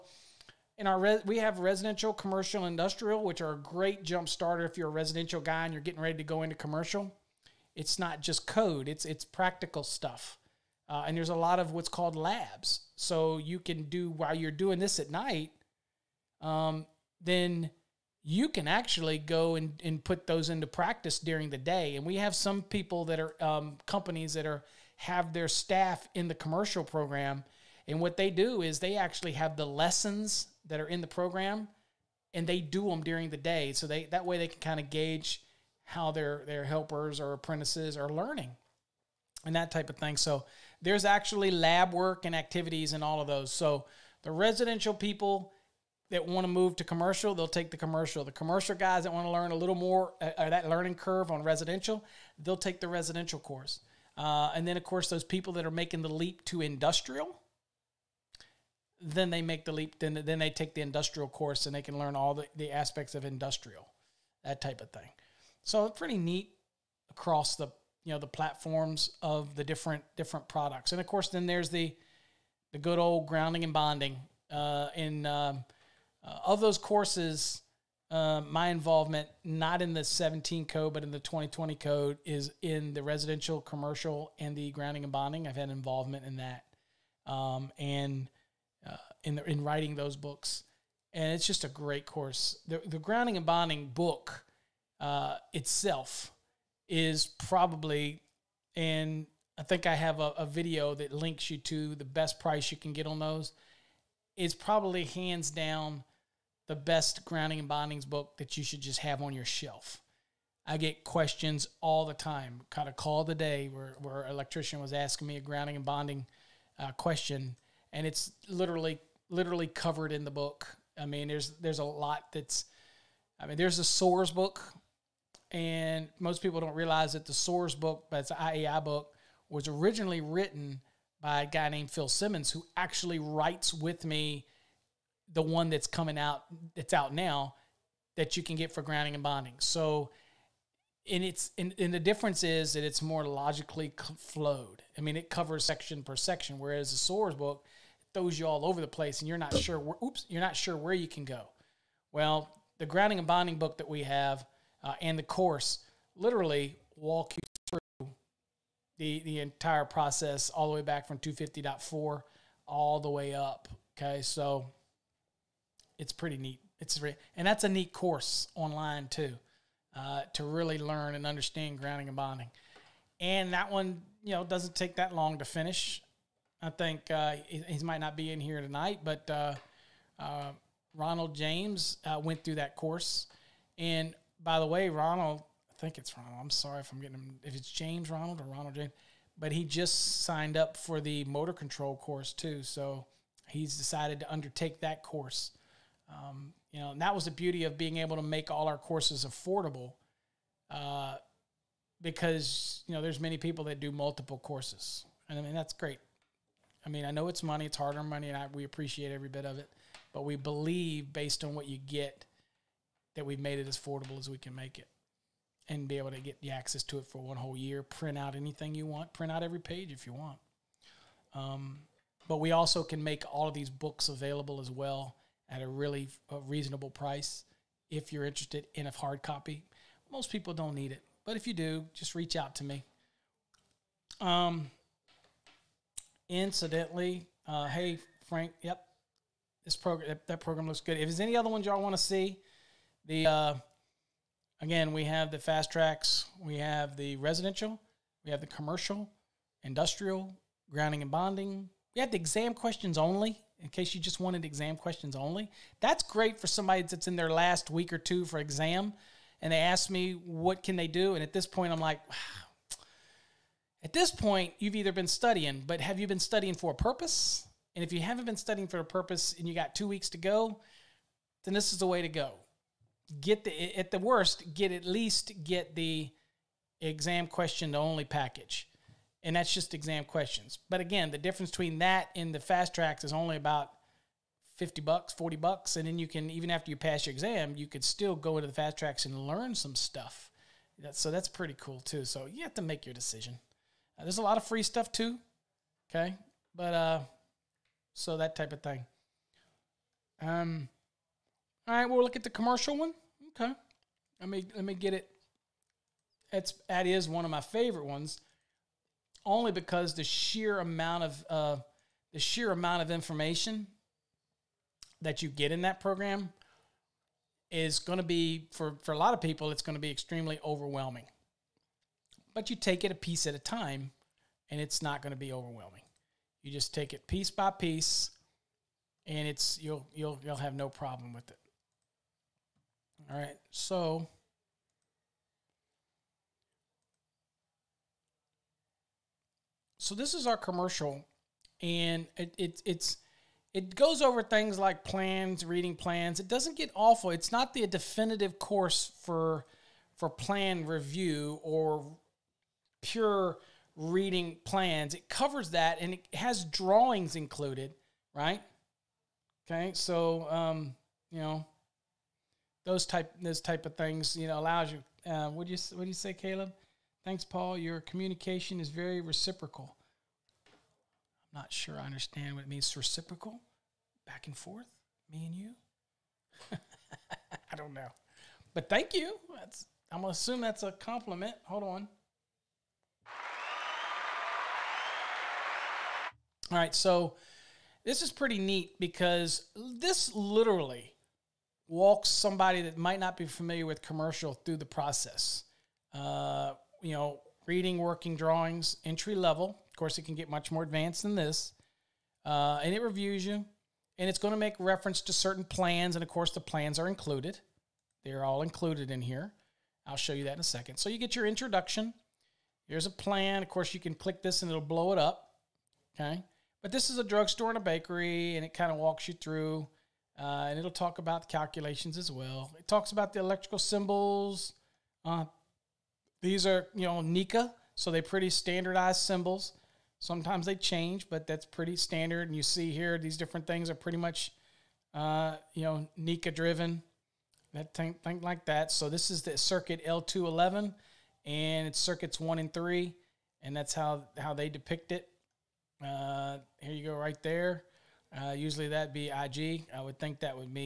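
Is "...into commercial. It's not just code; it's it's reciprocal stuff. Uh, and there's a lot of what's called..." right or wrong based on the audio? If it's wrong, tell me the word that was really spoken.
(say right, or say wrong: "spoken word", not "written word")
wrong: "practical", not "reciprocal".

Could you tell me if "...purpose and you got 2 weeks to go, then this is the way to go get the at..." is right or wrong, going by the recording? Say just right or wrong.
right.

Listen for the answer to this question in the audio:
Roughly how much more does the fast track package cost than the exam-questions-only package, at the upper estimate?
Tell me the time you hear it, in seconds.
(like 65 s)
284 s.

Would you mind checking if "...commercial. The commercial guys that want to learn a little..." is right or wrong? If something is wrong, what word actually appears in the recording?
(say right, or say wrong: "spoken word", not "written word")
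right.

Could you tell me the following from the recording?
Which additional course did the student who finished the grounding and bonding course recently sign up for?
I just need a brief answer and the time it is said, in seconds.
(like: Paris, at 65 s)
Motor control, at 191 s.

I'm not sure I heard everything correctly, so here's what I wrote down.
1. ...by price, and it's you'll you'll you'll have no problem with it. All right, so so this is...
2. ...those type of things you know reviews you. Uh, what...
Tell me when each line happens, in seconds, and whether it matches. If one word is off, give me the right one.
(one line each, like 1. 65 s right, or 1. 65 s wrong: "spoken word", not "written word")
1. 327 s wrong: "piece", not "price"
2. 363 s wrong: "allows", not "reviews".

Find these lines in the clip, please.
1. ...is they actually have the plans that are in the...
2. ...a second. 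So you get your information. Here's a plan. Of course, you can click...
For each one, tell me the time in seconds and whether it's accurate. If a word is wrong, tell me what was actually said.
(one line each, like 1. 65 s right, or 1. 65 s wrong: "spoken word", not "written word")
1. 28 s wrong: "lessons", not "plans"
2. 410 s wrong: "introduction", not "information".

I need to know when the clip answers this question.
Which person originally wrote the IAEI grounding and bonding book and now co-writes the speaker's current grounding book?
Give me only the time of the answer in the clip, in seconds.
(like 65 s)
131 s.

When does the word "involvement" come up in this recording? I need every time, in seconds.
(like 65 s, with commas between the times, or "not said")
78 s, 85 s.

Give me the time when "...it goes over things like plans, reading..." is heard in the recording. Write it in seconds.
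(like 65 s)
343 s.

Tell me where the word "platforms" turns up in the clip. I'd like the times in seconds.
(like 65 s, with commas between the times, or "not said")
68 s.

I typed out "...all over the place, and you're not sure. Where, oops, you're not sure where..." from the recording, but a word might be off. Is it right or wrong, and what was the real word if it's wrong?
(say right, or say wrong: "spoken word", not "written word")
right.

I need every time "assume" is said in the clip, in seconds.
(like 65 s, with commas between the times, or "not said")
380 s.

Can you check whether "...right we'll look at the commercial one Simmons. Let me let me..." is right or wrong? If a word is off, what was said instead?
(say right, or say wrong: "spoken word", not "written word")
wrong: "Okay", not "Simmons".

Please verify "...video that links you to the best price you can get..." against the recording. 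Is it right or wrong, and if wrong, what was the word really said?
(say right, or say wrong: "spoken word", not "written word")
right.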